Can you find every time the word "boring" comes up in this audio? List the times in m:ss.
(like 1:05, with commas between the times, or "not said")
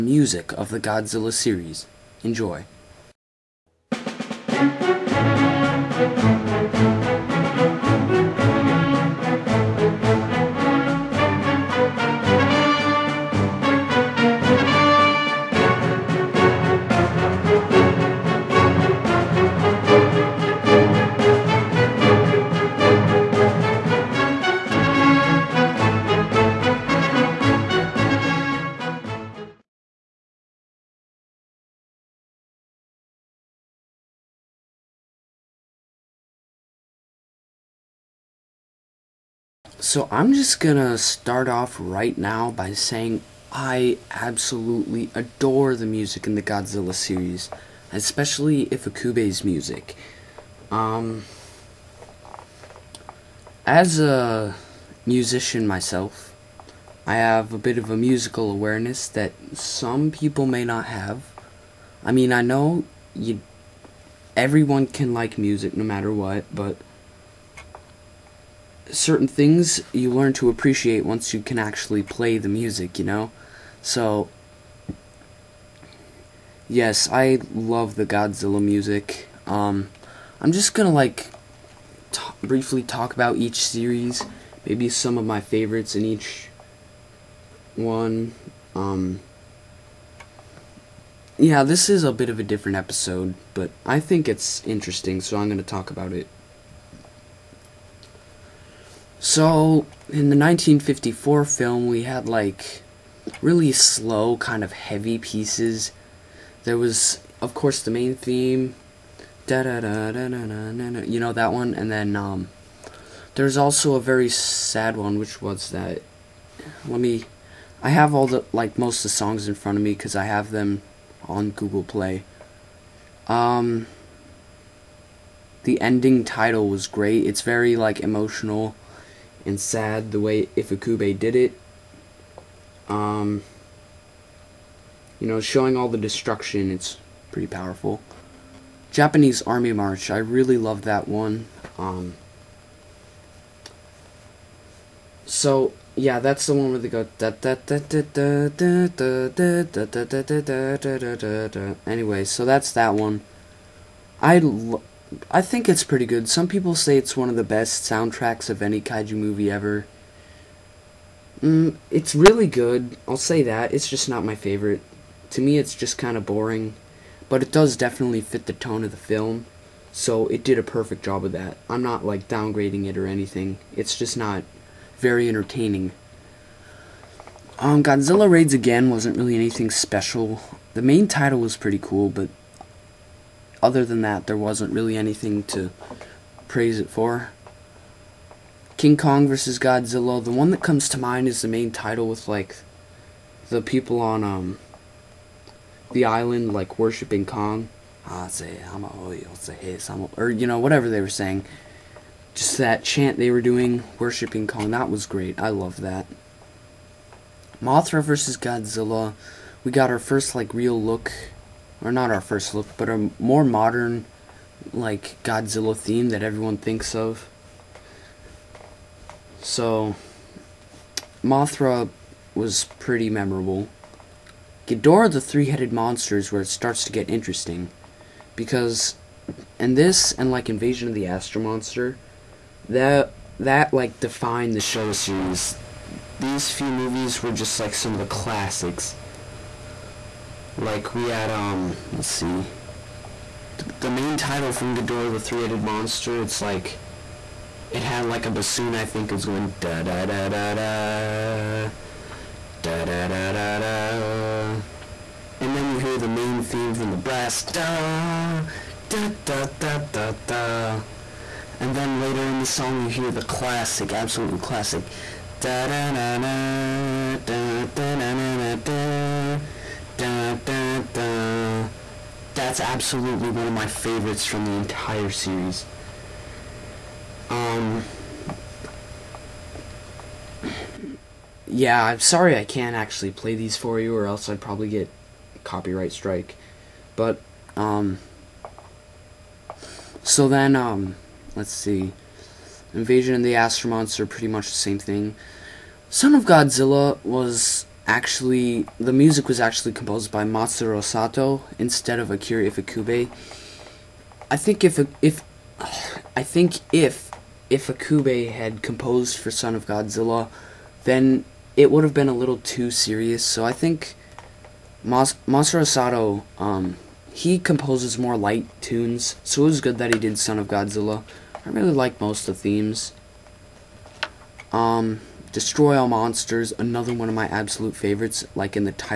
2:46.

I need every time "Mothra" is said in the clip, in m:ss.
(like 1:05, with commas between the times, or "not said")
3:27, 3:41.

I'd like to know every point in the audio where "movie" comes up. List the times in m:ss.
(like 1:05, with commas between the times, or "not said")
2:39, 3:56.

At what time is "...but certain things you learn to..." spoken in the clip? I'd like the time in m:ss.
1:06.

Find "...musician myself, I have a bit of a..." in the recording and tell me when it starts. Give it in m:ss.
0:55.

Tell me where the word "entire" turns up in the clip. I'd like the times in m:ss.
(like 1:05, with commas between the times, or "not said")
4:34.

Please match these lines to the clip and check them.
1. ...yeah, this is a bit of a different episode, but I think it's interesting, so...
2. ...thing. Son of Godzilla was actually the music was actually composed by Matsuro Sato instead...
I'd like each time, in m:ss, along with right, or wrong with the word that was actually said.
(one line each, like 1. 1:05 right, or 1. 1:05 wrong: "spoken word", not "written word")
1. 1:31 right
2. 4:54 right.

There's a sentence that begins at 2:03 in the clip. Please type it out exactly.
Um, the ending title was great.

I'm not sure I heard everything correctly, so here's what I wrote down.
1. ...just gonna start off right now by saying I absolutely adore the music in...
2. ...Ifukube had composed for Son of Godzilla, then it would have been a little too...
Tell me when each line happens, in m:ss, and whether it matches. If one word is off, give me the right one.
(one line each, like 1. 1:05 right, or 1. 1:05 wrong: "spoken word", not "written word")
1. 0:40 right
2. 5:07 right.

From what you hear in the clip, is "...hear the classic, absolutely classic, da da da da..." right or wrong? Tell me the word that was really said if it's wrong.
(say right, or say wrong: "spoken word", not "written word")
right.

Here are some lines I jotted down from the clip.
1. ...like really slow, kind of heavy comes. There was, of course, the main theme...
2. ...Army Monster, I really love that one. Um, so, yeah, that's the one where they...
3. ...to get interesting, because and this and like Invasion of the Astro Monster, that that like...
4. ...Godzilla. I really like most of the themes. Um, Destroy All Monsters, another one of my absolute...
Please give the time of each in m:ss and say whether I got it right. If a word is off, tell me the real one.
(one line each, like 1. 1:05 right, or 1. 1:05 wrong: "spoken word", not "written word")
1. 1:42 wrong: "pieces", not "comes"
2. 2:19 wrong: "March", not "Monster"
3. 3:46 right
4. 5:20 right.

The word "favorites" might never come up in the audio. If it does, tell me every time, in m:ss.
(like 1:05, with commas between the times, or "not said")
1:25, 2:44, 4:33, 5:27.